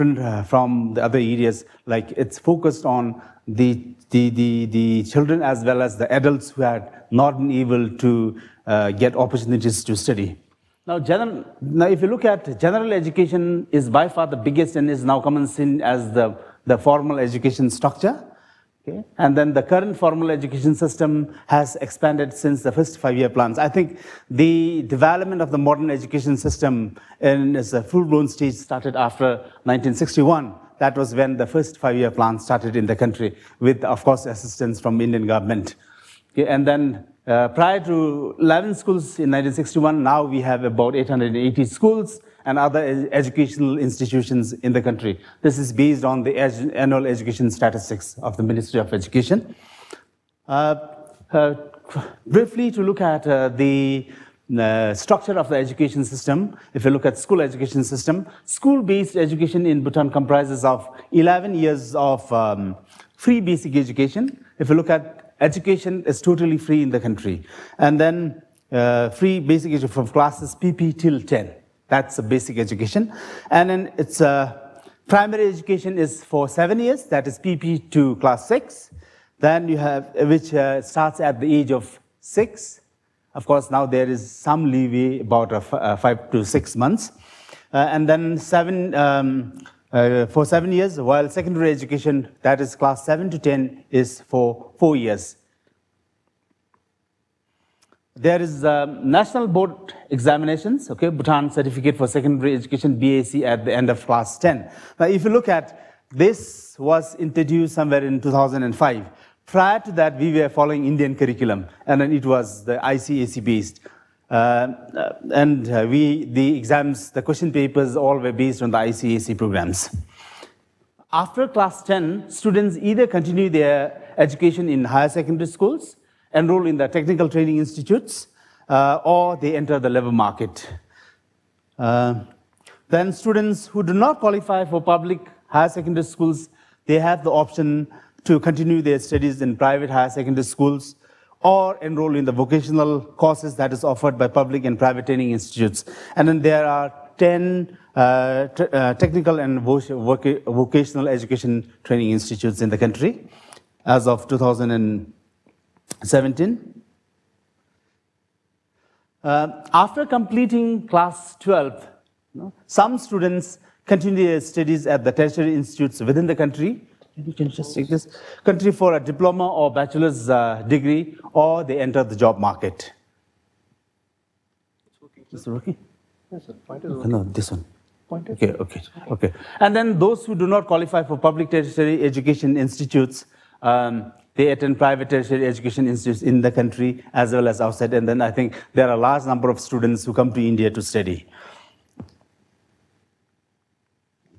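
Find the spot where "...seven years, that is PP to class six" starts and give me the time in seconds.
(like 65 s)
76 s.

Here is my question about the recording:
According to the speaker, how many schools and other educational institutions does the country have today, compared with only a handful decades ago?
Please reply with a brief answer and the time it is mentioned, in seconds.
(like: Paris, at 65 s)
880, at 40 s.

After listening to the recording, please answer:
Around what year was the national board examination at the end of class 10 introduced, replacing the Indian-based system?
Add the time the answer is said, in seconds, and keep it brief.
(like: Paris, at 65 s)
2005, at 108 s.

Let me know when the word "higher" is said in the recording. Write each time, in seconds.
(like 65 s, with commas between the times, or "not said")
124 s, 135 s, 139 s.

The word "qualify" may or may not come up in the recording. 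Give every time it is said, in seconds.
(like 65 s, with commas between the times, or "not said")
134 s, 180 s.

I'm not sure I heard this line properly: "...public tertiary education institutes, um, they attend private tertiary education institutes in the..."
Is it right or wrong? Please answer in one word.
right.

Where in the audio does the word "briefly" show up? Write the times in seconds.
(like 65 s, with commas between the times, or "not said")
52 s.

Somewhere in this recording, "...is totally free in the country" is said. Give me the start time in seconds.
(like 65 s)
66 s.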